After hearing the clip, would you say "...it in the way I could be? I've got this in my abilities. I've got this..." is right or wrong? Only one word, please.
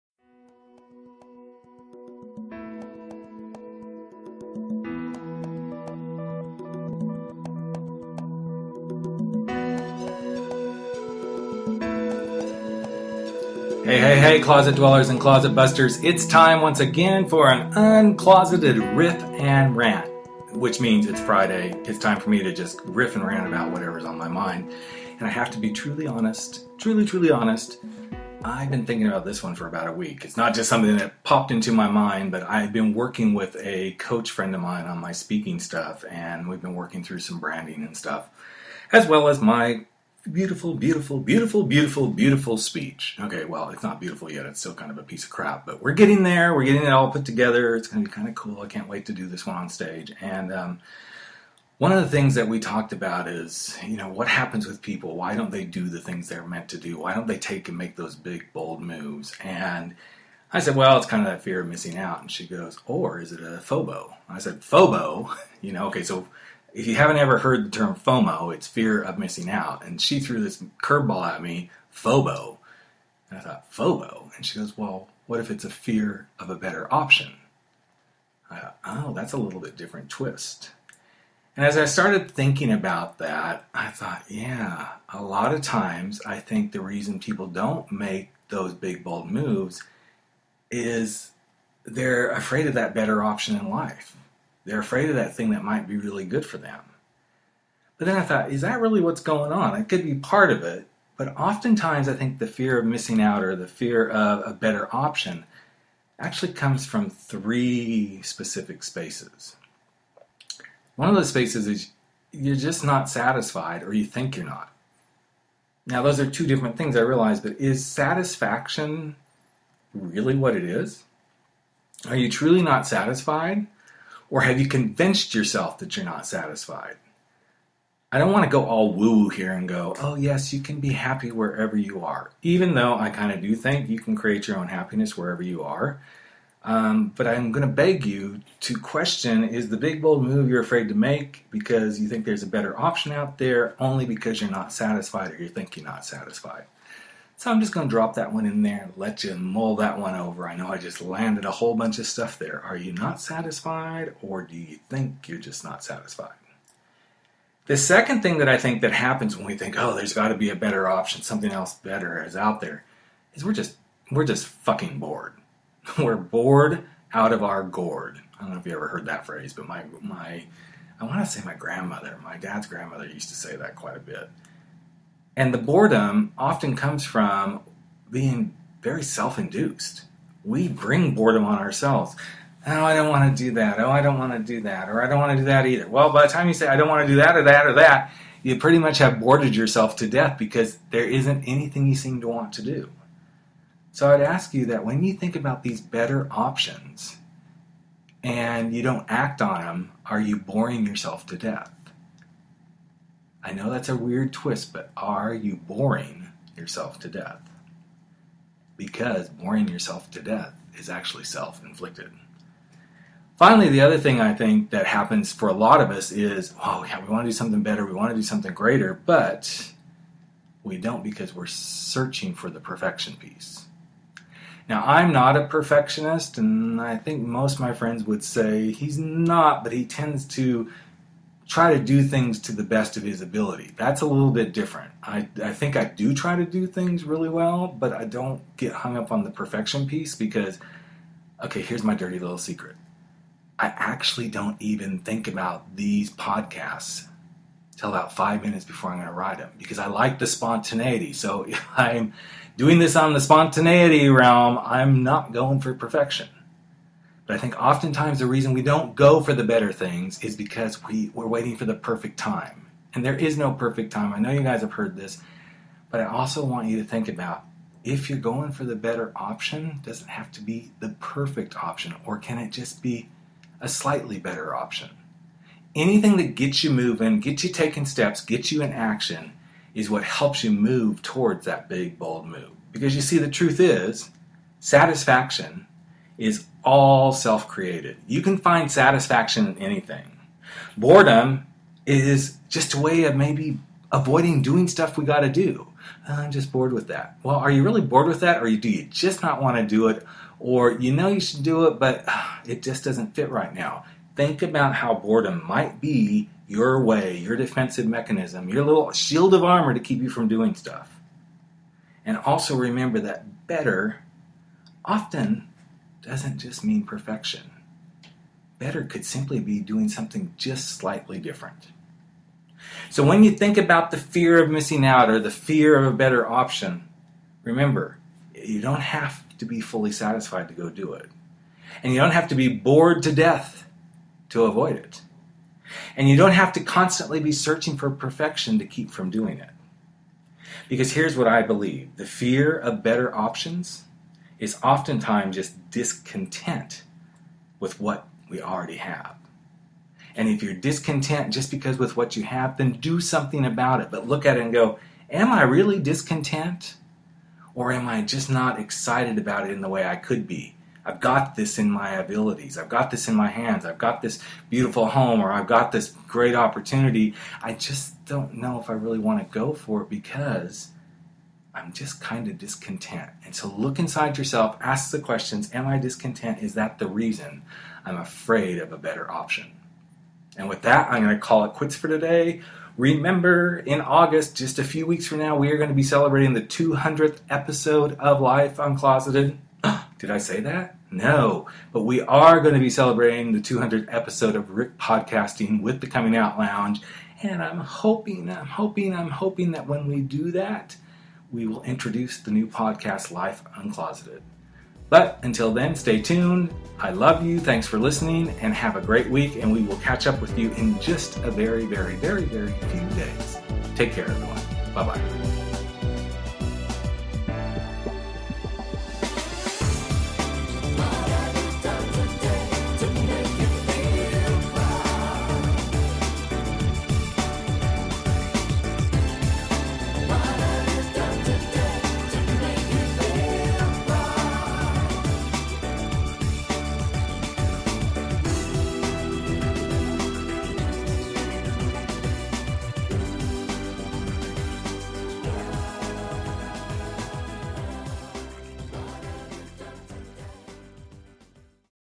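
right.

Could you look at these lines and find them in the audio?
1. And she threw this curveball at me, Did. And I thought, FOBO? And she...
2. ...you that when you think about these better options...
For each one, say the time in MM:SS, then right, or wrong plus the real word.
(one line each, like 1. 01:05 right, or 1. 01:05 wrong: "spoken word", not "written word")
1. 01:09 wrong: "FOBO", not "Did"
2. 03:14 right.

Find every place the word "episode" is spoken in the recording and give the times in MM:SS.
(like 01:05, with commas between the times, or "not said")
06:27, 06:33.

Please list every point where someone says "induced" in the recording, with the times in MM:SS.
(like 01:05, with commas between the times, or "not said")
02:59.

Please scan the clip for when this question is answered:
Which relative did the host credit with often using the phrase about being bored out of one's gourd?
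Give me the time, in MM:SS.
02:52.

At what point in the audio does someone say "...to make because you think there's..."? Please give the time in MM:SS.
02:20.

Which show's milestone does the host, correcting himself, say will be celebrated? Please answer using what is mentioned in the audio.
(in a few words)
The Coming Out Lounge.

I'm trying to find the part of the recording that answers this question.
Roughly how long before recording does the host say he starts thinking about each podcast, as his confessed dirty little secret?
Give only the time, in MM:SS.
04:08.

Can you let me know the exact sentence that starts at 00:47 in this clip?
It's going to be kind of cool.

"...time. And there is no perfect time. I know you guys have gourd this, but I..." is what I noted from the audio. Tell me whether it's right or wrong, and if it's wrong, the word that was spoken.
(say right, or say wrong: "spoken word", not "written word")
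wrong: "heard", not "gourd".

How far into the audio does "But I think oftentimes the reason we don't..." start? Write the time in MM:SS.
04:17.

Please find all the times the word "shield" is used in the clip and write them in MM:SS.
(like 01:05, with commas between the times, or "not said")
05:08.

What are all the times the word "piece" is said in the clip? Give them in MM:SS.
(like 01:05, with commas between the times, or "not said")
00:45, 03:43, 03:59.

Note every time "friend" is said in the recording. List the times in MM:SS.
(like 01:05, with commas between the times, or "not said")
00:34, 03:47.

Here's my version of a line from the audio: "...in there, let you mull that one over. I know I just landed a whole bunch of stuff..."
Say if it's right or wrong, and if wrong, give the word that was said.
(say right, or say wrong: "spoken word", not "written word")
right.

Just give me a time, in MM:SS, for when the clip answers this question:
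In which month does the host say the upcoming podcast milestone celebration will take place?
06:23.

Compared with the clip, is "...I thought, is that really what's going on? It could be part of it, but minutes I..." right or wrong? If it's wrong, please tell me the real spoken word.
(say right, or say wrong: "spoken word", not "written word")
wrong: "oftentimes", not "minutes".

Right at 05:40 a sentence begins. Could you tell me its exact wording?
Because here's what I believe the fear of better options is oftentimes just discontent with what we already have.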